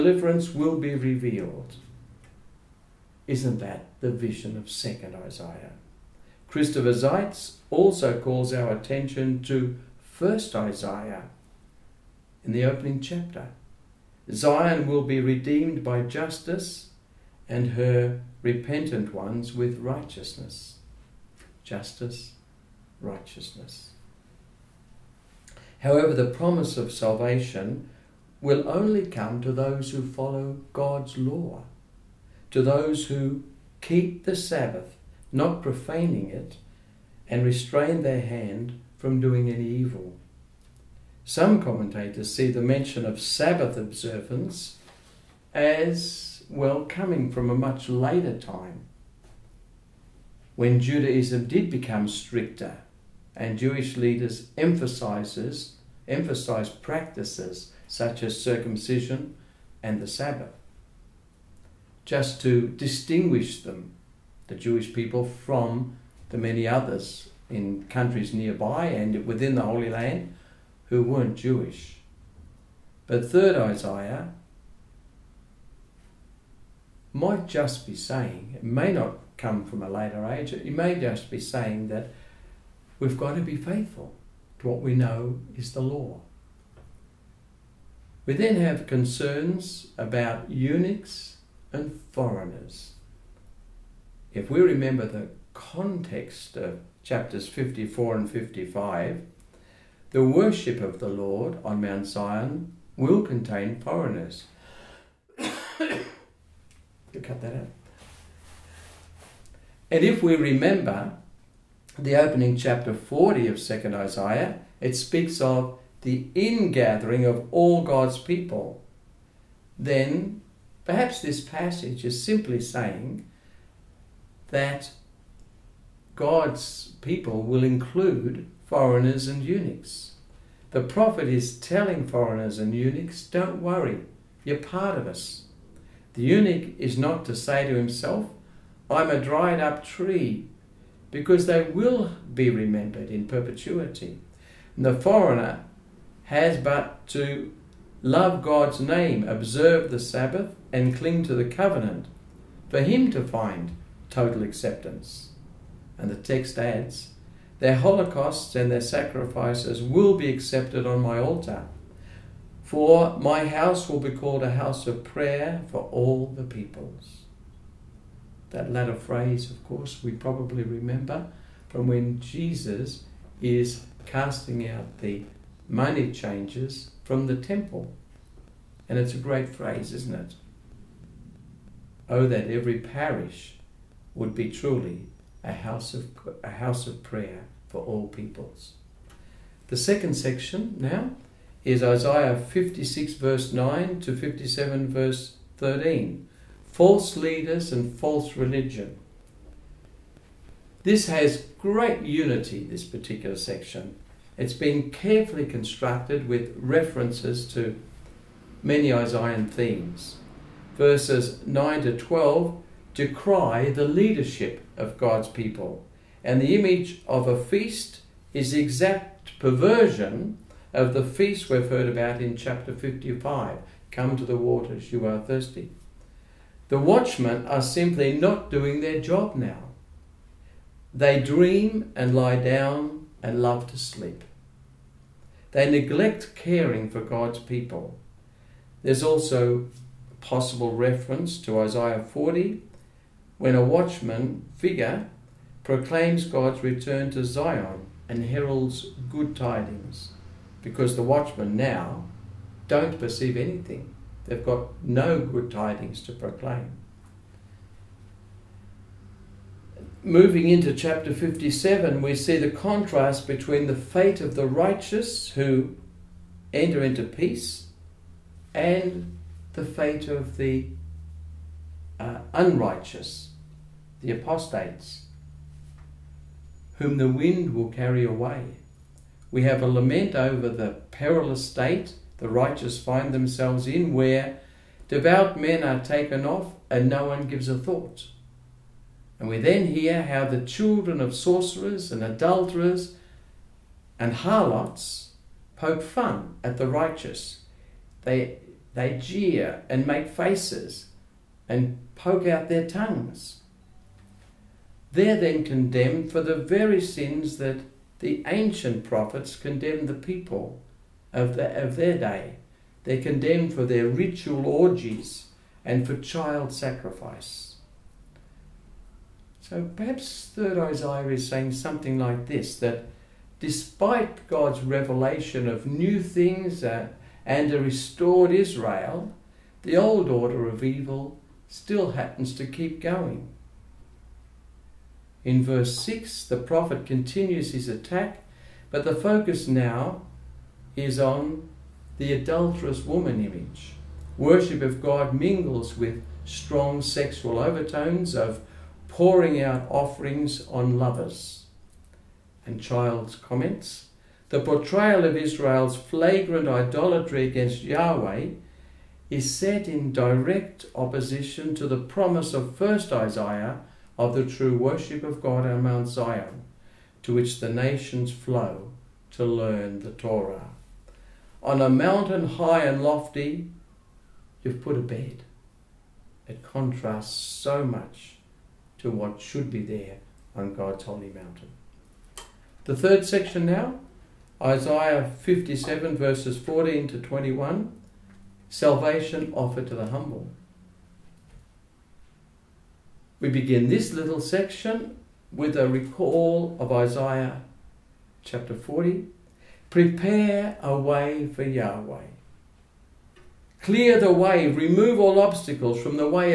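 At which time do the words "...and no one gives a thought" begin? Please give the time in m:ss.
4:46.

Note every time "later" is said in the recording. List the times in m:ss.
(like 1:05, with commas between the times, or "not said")
0:47, 1:19.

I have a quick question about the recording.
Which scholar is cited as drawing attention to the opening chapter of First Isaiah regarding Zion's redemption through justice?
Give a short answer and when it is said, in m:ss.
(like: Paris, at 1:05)
Christopher Seitz, at 0:06.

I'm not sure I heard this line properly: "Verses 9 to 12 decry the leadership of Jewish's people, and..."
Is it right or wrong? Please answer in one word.
wrong.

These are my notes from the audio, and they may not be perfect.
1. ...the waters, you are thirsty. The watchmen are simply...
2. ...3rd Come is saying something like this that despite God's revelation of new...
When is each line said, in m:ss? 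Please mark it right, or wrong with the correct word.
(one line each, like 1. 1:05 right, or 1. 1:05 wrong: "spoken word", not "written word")
1. 3:44 right
2. 5:20 wrong: "Isaiah", not "Come".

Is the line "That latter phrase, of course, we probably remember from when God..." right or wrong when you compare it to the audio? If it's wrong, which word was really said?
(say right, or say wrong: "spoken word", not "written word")
wrong: "Jesus", not "God".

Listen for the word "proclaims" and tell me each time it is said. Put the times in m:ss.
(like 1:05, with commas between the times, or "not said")
4:05, 4:16.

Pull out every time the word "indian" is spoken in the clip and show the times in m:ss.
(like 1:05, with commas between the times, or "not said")
not said.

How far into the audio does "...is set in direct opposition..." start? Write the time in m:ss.
5:59.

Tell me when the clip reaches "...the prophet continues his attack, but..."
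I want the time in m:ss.
5:36.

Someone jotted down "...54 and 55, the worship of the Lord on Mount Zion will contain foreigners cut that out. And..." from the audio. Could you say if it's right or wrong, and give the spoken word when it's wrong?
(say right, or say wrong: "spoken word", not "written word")
right.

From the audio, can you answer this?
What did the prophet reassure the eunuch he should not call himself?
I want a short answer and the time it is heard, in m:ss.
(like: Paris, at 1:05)
A dried up tree, at 2:19.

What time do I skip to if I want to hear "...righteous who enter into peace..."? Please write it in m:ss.
4:24.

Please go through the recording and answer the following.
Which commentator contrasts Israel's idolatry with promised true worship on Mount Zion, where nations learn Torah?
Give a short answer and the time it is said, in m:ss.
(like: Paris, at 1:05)
Childs, at 5:52.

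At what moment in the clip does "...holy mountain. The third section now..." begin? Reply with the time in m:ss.
6:20.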